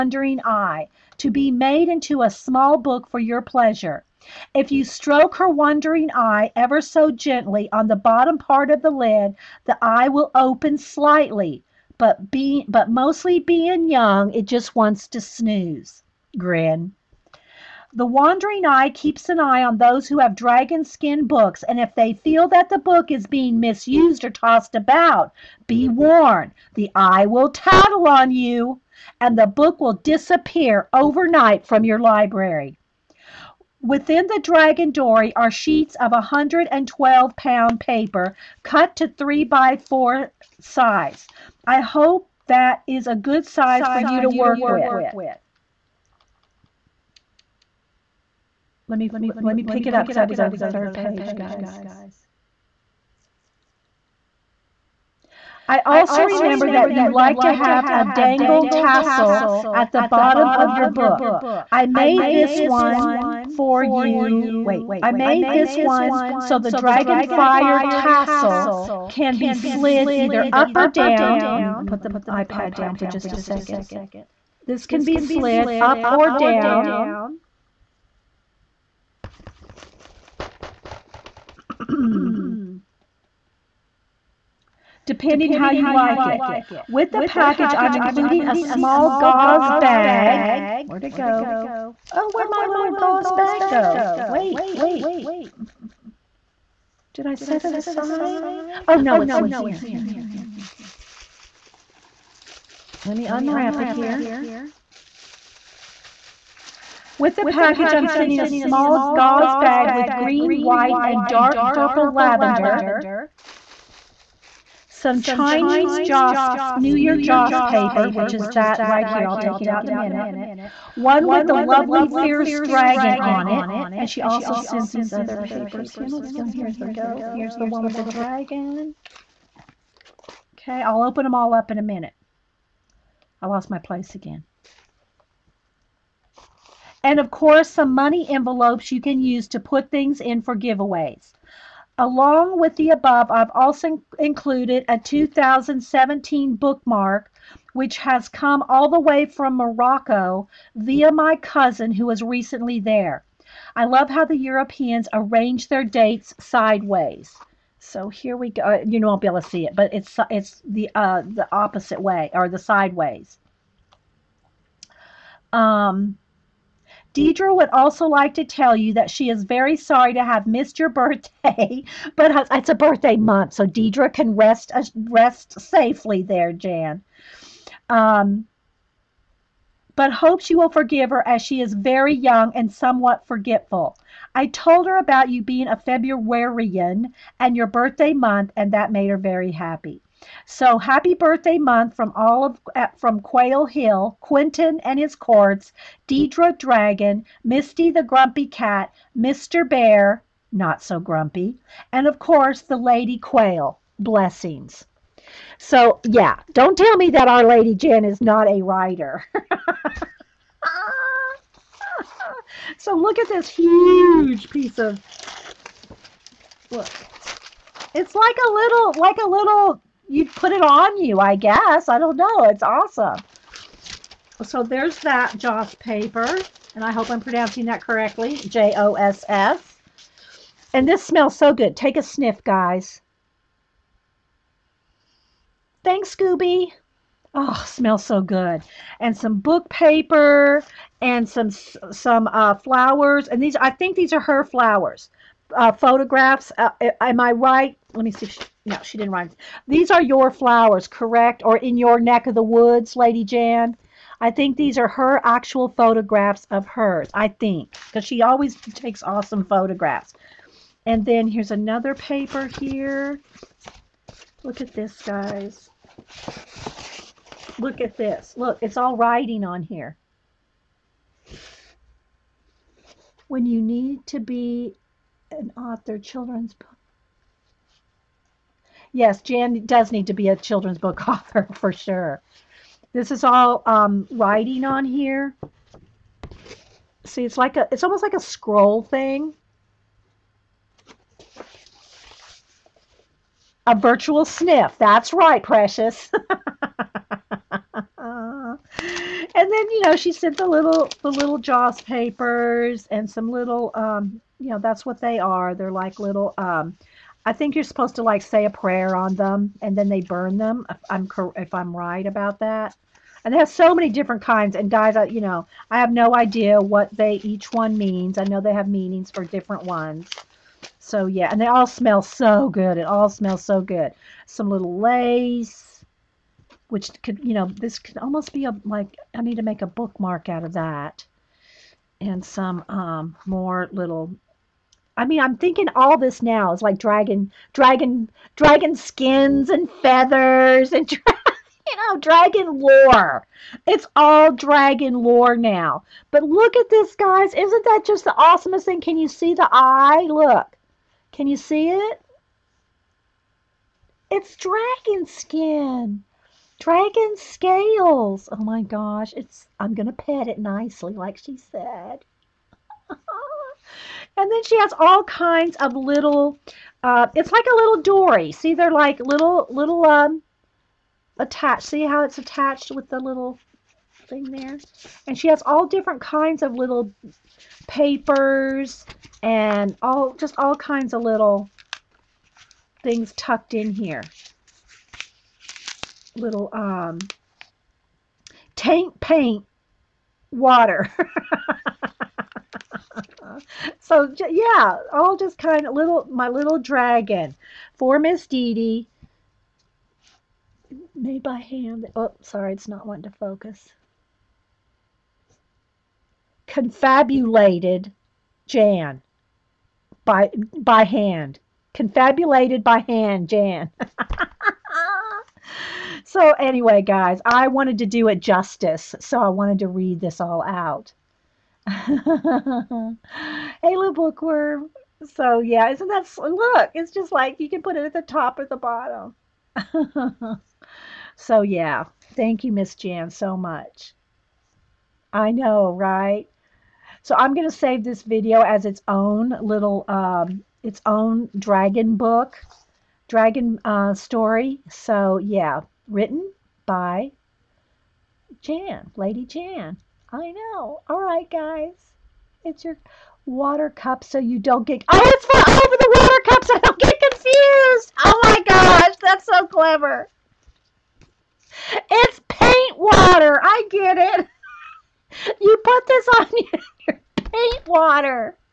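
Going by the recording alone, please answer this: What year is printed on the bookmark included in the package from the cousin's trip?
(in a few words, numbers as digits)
2017.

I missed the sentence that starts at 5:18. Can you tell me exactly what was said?
I know they have meanings for different ones.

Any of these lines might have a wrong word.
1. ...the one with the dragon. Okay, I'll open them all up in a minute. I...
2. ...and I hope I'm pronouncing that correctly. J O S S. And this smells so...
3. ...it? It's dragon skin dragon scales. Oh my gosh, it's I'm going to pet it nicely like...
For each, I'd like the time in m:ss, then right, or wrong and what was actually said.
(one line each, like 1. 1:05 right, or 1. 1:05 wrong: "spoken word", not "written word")
1. 2:07 right
2. 3:46 right
3. 5:51 right.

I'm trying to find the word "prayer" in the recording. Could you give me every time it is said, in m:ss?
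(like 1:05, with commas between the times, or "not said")
5:08.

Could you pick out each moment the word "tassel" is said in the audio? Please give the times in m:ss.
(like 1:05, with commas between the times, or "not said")
0:58, 1:07.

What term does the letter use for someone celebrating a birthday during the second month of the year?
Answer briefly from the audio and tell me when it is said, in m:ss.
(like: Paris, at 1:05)
Februarian, at 3:05.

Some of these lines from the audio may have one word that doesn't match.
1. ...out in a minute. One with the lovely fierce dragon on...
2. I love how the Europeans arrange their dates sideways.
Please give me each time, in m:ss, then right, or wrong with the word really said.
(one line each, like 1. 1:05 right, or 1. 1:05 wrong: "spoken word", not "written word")
1. 1:59 right
2. 2:33 right.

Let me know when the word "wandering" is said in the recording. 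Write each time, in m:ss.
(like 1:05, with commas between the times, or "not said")
0:05, 0:18.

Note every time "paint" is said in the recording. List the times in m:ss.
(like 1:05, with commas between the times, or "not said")
6:29, 7:42, 7:47.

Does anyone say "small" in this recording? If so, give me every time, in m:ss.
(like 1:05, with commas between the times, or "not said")
0:02, 1:28, 1:48.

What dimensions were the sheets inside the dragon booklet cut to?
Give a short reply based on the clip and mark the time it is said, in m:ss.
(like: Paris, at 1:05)
3 by 4, at 0:39.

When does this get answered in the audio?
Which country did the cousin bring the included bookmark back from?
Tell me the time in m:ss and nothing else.
2:29.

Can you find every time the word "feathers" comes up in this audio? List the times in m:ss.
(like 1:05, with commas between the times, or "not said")
5:39.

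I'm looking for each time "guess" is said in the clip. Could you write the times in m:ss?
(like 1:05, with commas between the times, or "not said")
3:41.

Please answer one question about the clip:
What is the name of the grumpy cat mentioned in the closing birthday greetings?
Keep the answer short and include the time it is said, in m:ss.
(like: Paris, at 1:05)
Misty, at 3:17.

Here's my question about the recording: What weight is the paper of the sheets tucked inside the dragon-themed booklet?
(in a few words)
112 pound.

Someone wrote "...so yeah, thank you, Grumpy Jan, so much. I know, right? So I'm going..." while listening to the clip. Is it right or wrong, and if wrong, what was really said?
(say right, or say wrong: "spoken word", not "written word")
wrong: "Miss", not "Grumpy".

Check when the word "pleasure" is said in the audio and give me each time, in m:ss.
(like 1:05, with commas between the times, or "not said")
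0:03.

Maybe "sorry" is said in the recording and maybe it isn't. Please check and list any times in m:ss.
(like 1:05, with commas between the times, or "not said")
2:49, 6:42.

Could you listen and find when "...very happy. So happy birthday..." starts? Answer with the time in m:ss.
3:09.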